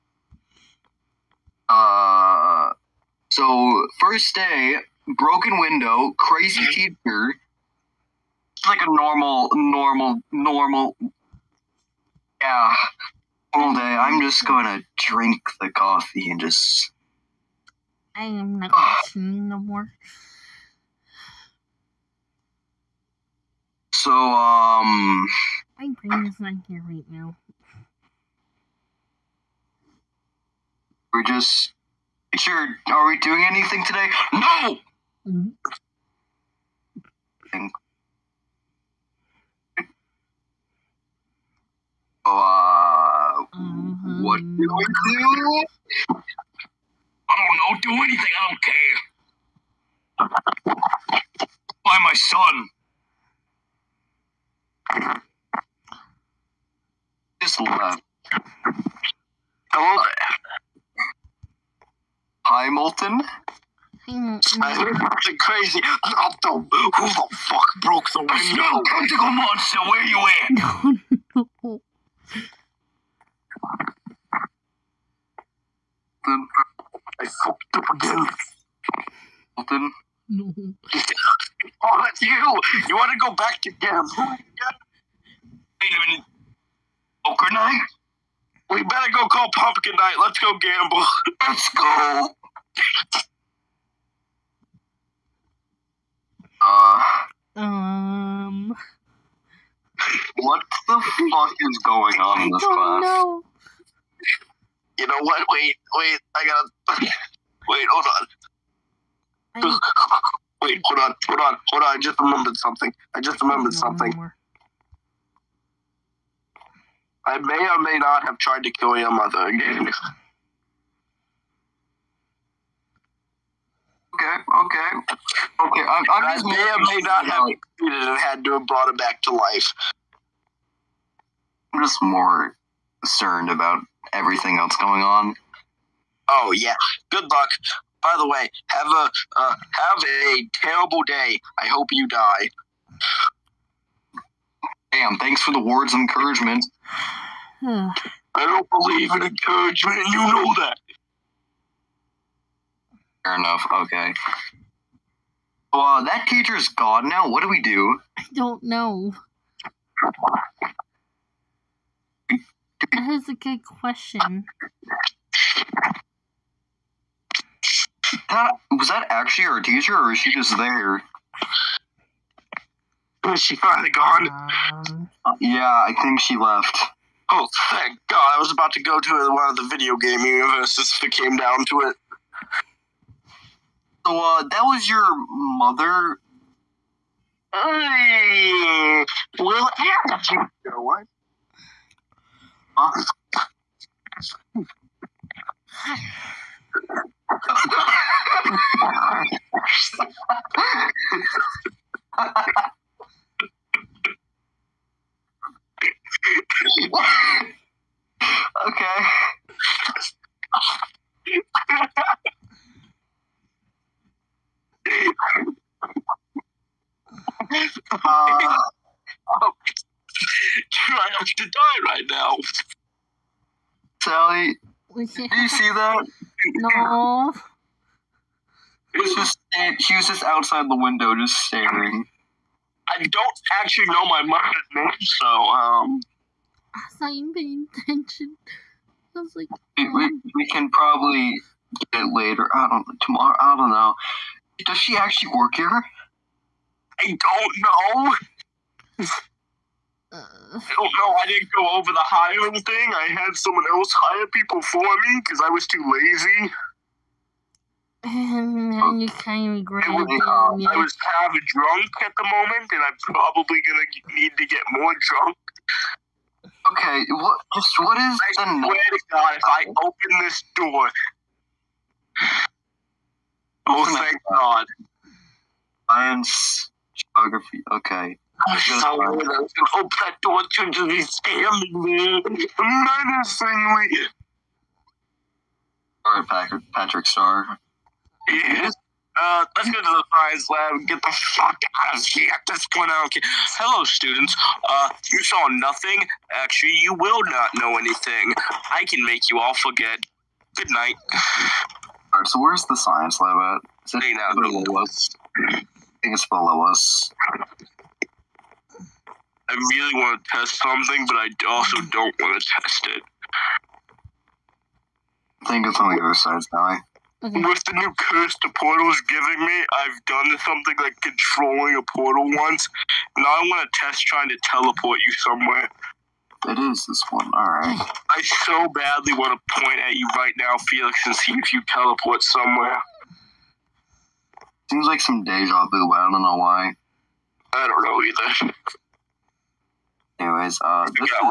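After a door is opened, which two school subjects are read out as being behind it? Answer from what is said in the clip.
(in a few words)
Science, geography.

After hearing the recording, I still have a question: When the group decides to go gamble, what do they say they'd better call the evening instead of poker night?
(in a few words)
Pumpkin Night.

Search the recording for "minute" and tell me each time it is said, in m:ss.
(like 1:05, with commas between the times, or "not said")
1:26.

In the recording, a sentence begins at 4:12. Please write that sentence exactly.
I had someone else hire people for me because I was too lazy.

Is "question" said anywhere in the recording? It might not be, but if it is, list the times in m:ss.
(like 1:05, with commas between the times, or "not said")
2:43.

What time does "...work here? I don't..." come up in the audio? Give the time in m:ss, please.
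4:05.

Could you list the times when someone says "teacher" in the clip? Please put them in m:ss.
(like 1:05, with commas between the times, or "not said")
0:07, 2:36, 2:49.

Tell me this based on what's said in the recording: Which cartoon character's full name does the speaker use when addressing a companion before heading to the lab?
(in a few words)
Patrick Star.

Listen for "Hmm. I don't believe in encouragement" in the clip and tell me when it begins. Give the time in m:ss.
2:27.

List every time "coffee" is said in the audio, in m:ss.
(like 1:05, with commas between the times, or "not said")
0:15.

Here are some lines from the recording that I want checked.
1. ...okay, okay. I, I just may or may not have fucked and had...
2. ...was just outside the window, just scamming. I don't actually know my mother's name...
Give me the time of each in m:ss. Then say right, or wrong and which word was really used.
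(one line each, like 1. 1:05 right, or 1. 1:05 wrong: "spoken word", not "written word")
1. 2:04 wrong: "executed", not "fucked"
2. 3:49 wrong: "staring", not "scamming".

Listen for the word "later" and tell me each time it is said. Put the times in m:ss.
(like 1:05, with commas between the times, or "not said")
4:02.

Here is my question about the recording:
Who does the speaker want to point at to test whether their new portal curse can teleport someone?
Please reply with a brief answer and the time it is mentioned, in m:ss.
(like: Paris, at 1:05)
Felix, at 5:30.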